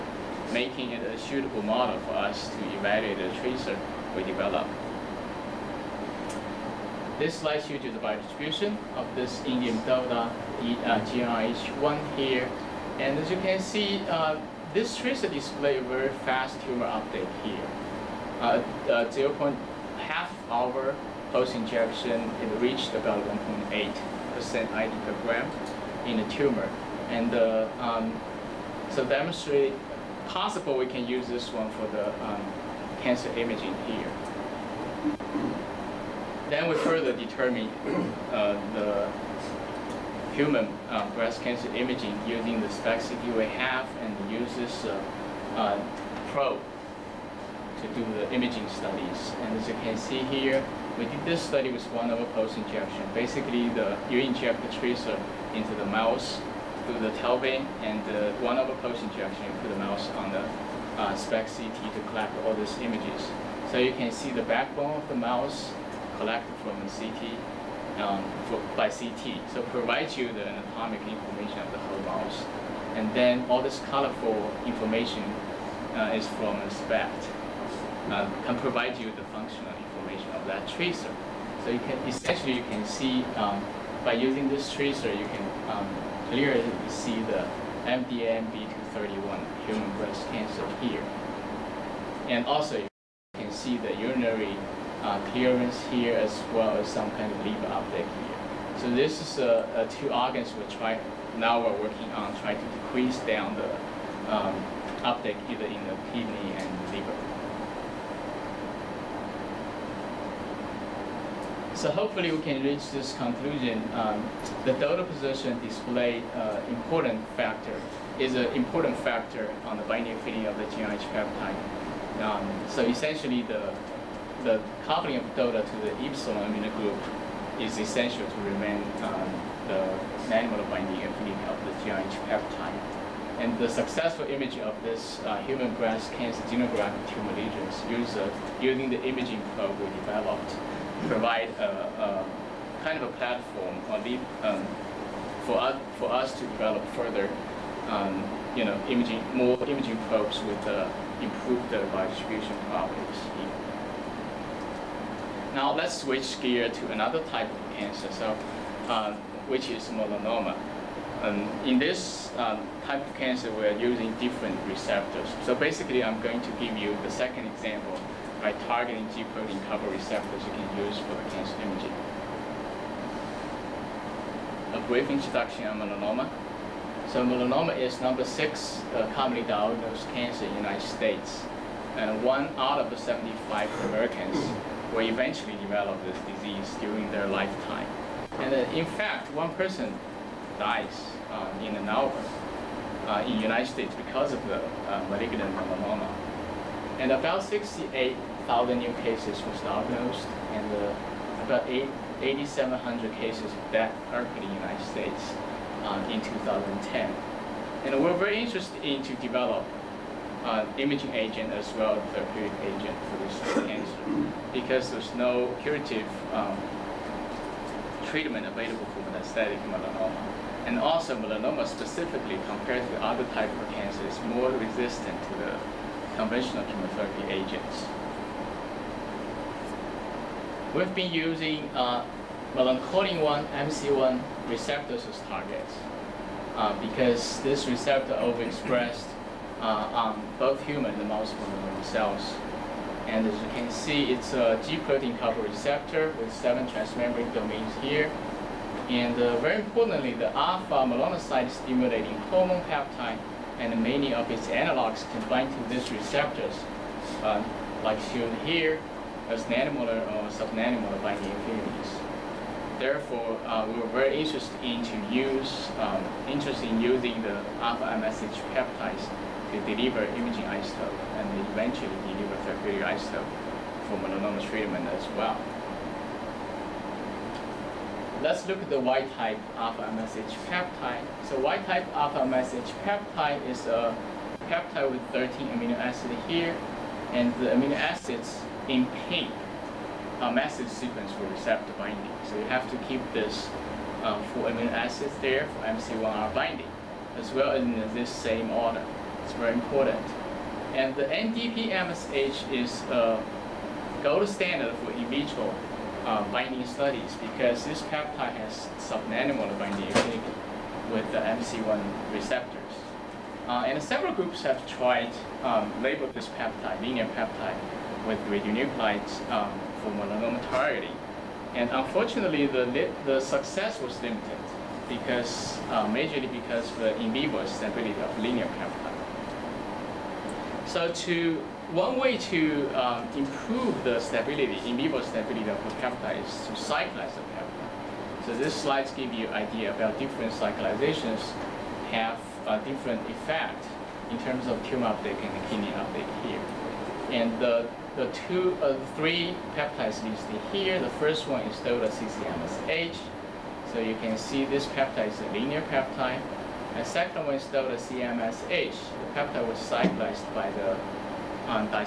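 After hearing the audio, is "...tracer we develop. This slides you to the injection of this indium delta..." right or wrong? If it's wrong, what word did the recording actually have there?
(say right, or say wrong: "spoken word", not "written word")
wrong: "biodistribution", not "injection".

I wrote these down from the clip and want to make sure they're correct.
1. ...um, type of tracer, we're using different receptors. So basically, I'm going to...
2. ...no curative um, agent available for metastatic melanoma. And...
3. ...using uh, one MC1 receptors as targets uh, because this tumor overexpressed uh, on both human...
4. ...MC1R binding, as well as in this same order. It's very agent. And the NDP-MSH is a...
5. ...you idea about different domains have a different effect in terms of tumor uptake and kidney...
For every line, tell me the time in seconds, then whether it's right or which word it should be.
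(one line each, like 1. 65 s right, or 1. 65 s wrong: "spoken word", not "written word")
1. 162 s wrong: "cancer", not "tracer"
2. 215 s wrong: "treatment", not "agent"
3. 231 s wrong: "receptor", not "tumor"
4. 295 s wrong: "important", not "agent"
5. 339 s wrong: "cyclizations", not "domains".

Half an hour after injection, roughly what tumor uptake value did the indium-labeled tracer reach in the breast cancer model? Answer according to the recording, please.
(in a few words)
1.8% ID per gram.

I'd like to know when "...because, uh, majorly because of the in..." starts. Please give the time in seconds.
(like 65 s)
324 s.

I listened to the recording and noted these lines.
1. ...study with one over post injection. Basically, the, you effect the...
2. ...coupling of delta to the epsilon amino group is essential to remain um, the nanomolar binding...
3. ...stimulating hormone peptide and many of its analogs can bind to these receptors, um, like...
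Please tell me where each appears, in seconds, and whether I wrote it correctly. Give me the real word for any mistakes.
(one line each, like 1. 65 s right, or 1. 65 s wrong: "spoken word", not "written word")
1. 51 s wrong: "inject", not "effect"
2. 124 s right
3. 251 s right.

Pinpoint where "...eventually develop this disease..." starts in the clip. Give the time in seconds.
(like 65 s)
185 s.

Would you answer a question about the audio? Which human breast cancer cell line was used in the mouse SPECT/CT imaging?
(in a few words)
MDMB231.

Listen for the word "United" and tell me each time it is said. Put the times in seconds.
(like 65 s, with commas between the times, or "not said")
180 s, 193 s, 204 s.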